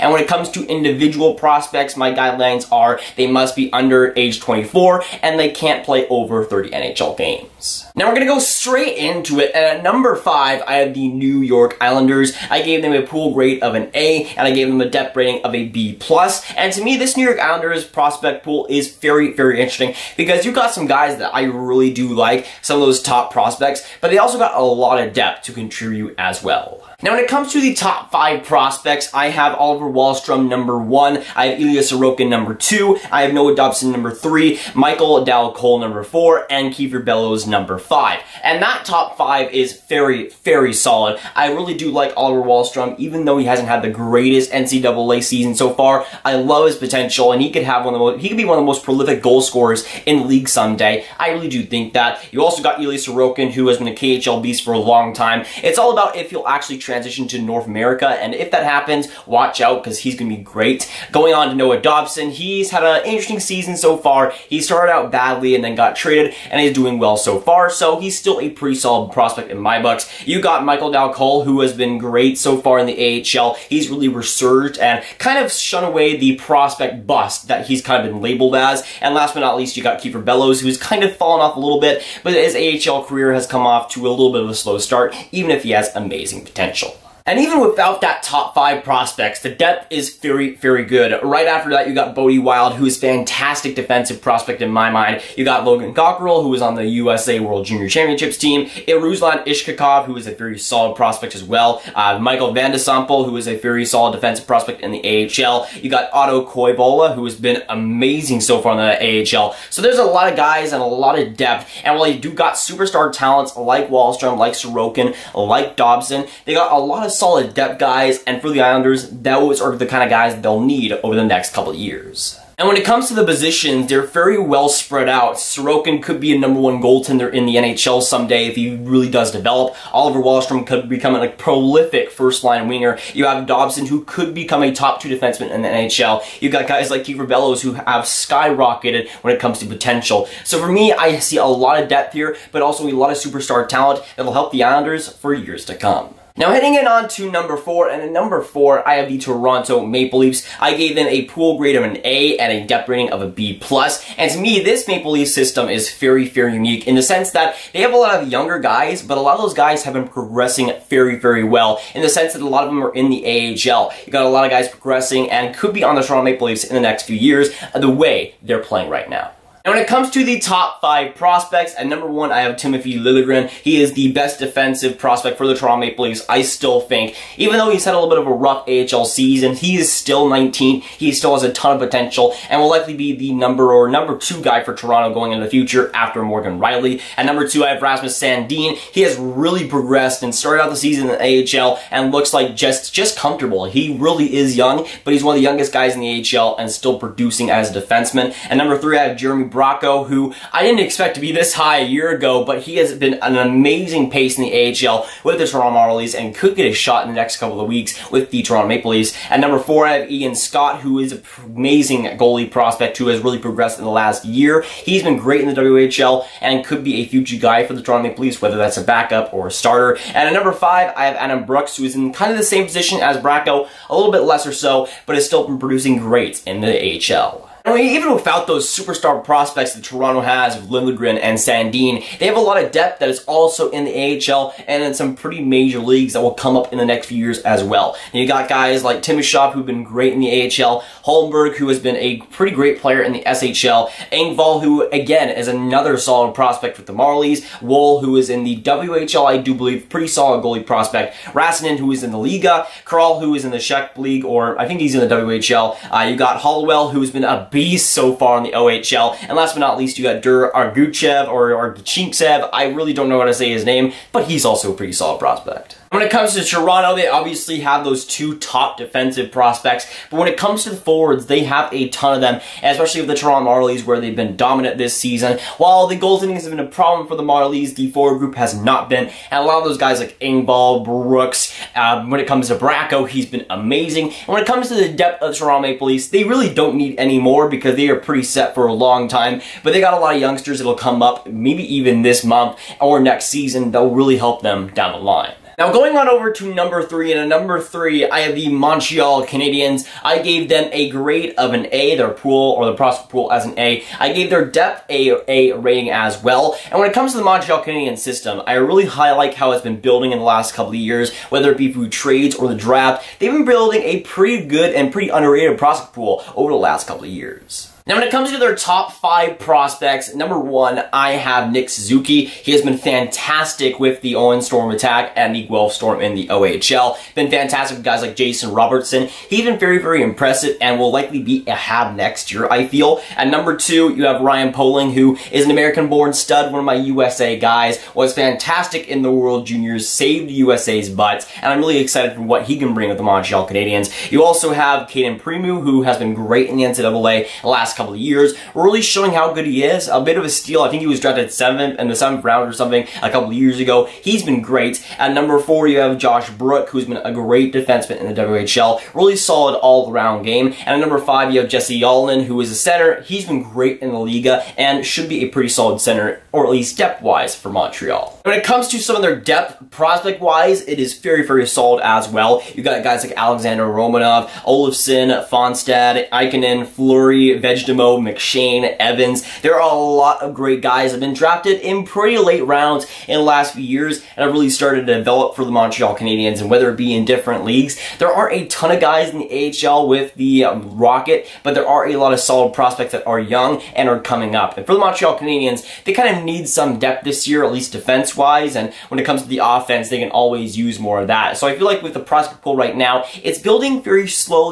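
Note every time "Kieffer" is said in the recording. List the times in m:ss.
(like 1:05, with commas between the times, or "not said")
0:36, 1:20, 2:17.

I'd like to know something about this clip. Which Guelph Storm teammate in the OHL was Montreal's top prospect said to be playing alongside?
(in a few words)
Jason Robertson.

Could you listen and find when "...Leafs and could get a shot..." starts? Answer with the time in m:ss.
3:25.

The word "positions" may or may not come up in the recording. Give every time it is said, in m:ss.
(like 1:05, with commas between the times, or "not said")
2:03, 3:42.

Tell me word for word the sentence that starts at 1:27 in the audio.
And even without that top five prospects, the depth is very, very good.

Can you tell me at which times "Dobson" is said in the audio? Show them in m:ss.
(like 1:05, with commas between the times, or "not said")
0:33, 1:01, 1:55, 2:13.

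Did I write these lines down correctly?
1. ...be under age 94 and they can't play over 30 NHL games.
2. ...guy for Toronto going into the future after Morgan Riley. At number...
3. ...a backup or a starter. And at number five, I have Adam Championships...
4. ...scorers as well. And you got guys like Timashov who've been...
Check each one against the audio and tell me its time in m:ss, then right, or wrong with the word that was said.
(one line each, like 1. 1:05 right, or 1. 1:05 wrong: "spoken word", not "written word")
1. 0:03 wrong: "24", not "94"
2. 3:04 right
3. 3:38 wrong: "Brooks", not "Championships"
4. 3:57 wrong: "years", not "scorers".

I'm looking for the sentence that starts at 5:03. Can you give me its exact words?
I gave their depth a A rating as well.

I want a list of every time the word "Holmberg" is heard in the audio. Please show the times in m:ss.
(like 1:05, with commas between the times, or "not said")
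4:01.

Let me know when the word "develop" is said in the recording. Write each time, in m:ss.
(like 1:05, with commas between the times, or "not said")
2:09, 6:24.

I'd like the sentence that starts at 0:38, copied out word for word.
And that top five is very, very solid.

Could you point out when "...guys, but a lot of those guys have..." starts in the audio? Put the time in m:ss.
2:38.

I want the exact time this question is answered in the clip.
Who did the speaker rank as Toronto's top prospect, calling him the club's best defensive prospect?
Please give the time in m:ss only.
2:52.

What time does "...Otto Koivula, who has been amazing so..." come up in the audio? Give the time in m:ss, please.
1:46.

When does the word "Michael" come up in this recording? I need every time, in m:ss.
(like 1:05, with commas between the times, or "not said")
0:34, 1:10, 1:42.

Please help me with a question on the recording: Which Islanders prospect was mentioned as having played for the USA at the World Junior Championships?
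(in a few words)
Logan Cockerill.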